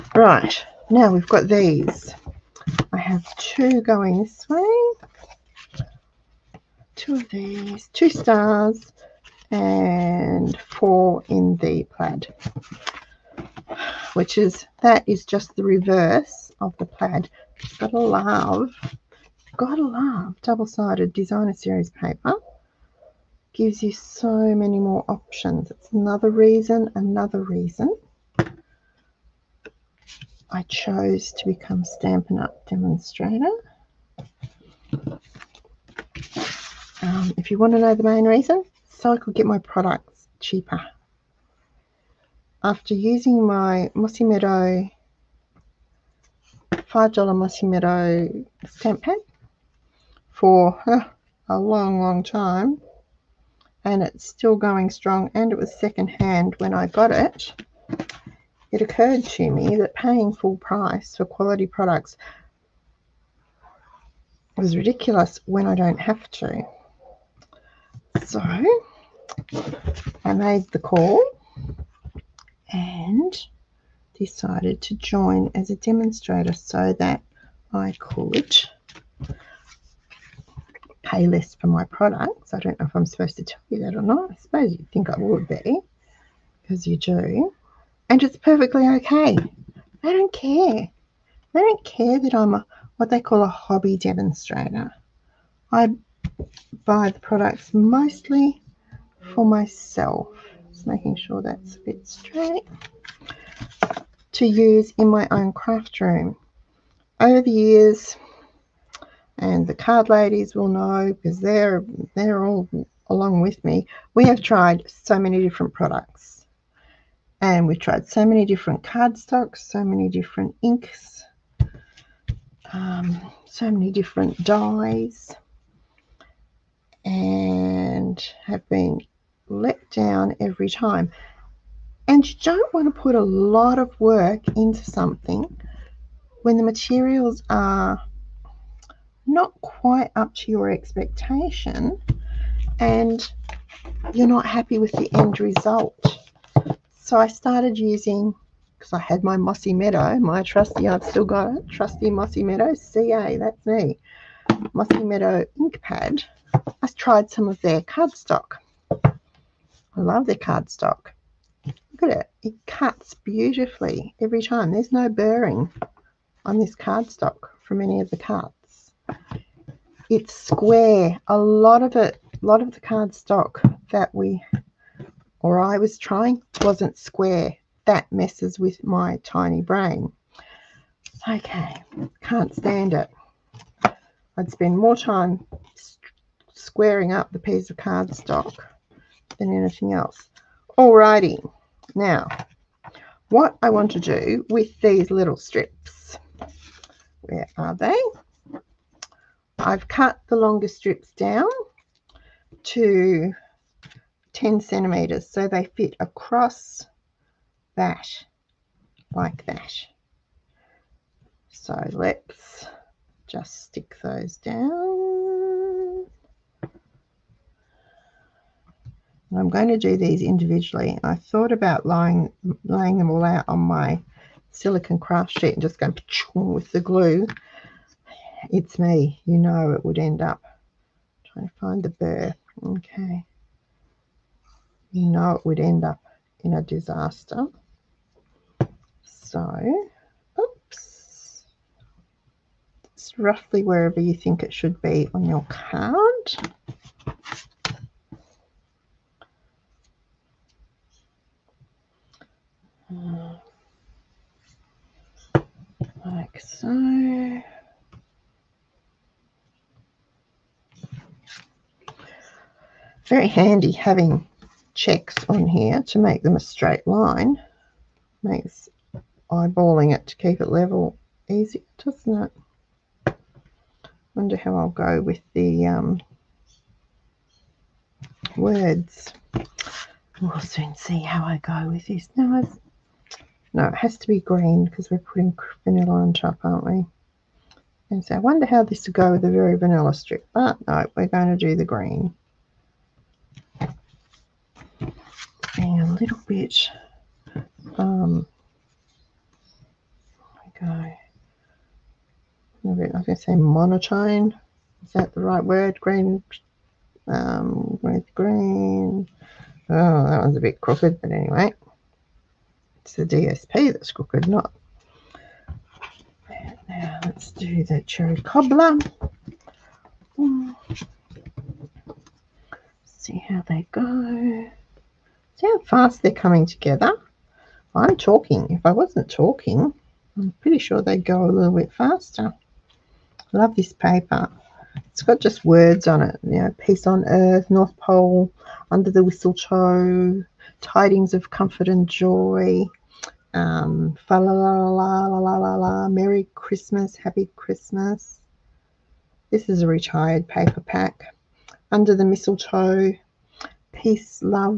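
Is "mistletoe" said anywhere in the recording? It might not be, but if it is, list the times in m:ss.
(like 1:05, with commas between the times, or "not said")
5:39, 5:52.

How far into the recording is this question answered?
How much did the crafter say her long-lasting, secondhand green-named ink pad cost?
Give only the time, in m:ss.
0:46.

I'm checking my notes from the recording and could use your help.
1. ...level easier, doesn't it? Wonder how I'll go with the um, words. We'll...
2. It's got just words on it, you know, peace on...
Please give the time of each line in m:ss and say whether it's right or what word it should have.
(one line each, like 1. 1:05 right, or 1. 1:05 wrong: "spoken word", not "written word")
1. 4:30 right
2. 5:34 right.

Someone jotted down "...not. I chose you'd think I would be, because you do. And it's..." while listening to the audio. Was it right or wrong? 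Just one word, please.
wrong.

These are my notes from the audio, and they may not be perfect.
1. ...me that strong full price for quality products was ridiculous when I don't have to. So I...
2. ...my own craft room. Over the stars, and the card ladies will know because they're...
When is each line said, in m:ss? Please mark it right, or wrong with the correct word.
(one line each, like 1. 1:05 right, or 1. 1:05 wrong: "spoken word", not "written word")
1. 0:59 wrong: "paying", not "strong"
2. 1:45 wrong: "years", not "stars".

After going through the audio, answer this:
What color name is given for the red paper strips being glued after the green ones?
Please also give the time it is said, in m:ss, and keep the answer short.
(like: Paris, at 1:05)
cherry cobbler, at 5:17.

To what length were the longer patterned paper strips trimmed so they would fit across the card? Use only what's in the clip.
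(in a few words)
10 centimeters.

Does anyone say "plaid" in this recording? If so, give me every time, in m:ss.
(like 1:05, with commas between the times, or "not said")
0:11, 0:16.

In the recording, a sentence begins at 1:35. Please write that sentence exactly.
I buy the products mostly for myself.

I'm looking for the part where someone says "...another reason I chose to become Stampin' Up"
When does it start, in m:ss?
0:26.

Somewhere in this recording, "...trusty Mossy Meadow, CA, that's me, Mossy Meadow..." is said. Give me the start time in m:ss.
2:31.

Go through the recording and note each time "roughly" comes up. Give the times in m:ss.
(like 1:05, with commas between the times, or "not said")
4:03.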